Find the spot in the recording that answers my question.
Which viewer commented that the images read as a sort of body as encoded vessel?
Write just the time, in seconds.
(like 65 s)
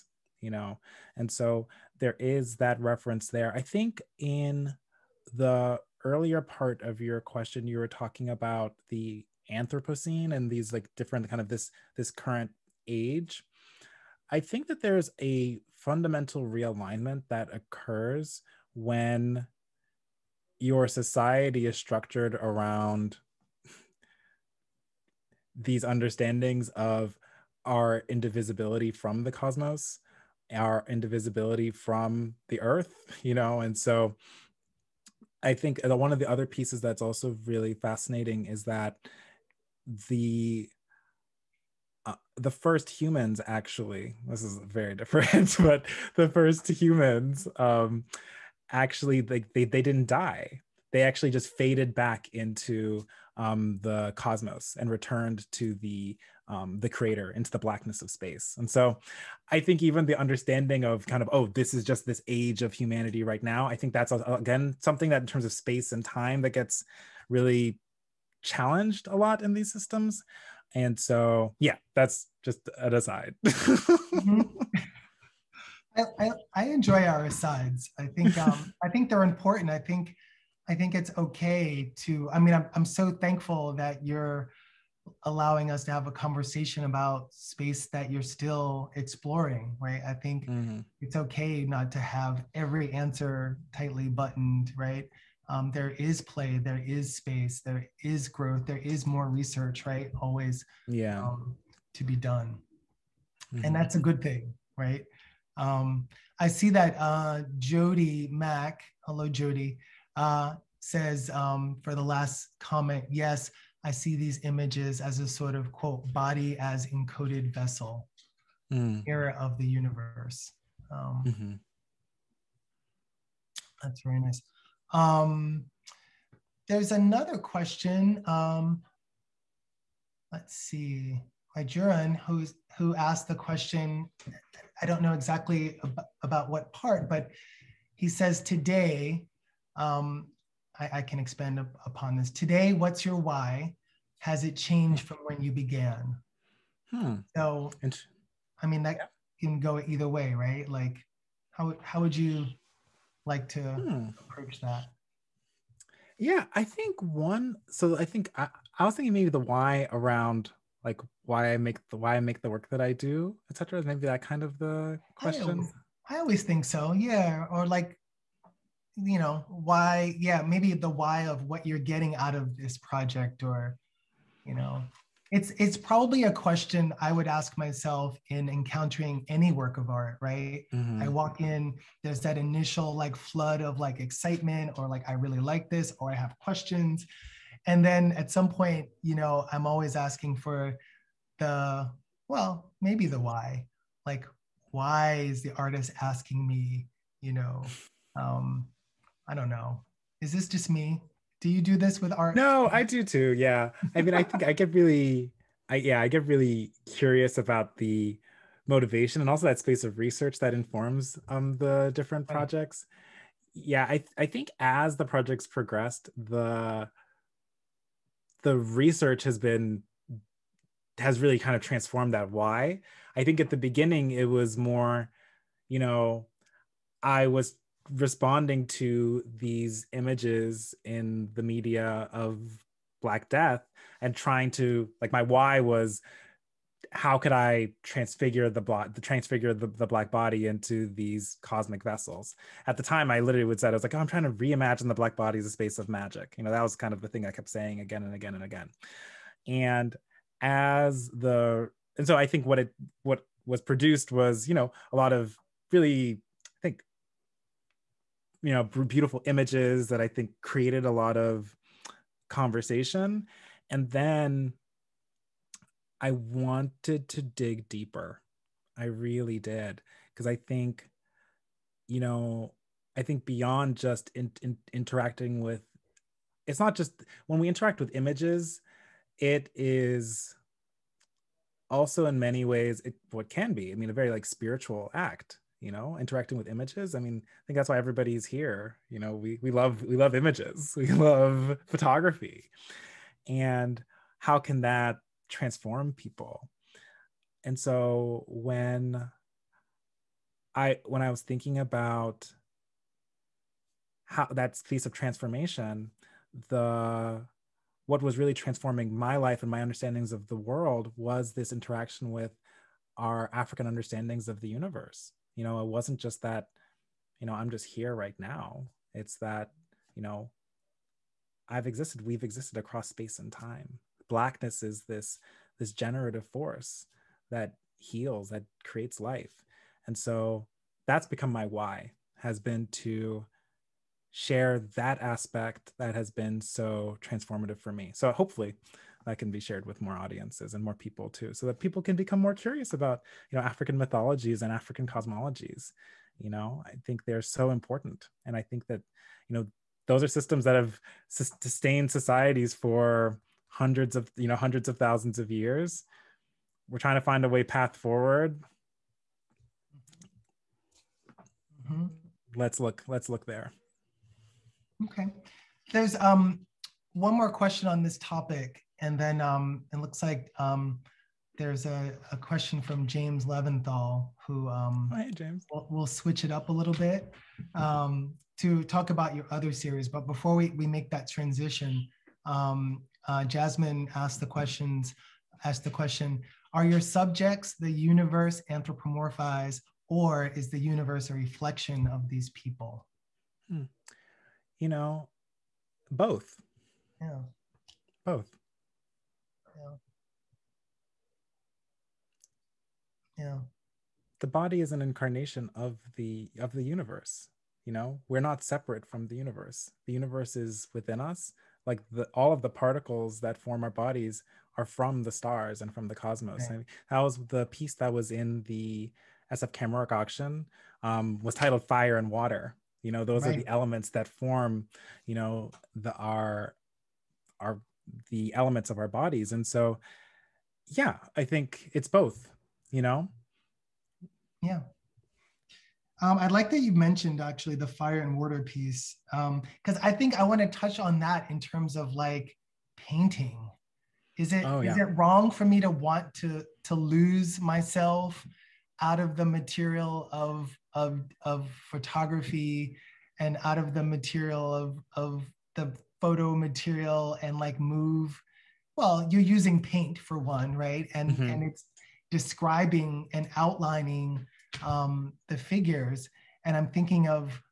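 107 s.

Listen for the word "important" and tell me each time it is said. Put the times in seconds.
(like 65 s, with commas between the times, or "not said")
79 s, 347 s.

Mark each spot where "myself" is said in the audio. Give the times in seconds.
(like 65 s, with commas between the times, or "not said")
177 s, 447 s.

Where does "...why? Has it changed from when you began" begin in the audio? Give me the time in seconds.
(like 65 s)
143 s.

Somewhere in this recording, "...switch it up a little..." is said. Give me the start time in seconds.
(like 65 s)
375 s.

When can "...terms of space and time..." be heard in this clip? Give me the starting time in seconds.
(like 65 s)
65 s.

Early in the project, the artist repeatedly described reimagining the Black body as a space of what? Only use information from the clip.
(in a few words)
Magic.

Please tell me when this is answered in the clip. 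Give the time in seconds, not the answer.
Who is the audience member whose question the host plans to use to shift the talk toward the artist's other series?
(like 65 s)
372 s.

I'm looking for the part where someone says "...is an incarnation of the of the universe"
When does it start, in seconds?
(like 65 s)
404 s.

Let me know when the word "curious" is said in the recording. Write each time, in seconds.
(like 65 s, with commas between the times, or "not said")
206 s, 342 s.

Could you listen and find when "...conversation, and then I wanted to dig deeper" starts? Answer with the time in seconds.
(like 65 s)
262 s.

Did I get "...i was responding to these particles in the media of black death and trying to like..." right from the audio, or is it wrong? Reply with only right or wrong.
wrong.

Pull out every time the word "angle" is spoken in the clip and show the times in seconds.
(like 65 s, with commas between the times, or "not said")
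not said.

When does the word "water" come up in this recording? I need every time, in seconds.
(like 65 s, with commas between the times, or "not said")
422 s, 438 s.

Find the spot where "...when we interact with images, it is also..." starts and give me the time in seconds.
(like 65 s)
277 s.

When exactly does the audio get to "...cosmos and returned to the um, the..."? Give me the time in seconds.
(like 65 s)
54 s.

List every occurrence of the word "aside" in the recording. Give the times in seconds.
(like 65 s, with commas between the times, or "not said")
72 s, 77 s.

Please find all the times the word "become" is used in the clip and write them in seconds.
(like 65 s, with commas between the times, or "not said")
331 s, 341 s.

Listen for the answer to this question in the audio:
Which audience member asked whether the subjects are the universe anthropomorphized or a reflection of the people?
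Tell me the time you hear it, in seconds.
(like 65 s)
383 s.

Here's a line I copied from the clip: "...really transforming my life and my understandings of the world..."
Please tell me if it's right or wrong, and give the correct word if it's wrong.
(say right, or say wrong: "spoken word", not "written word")
right.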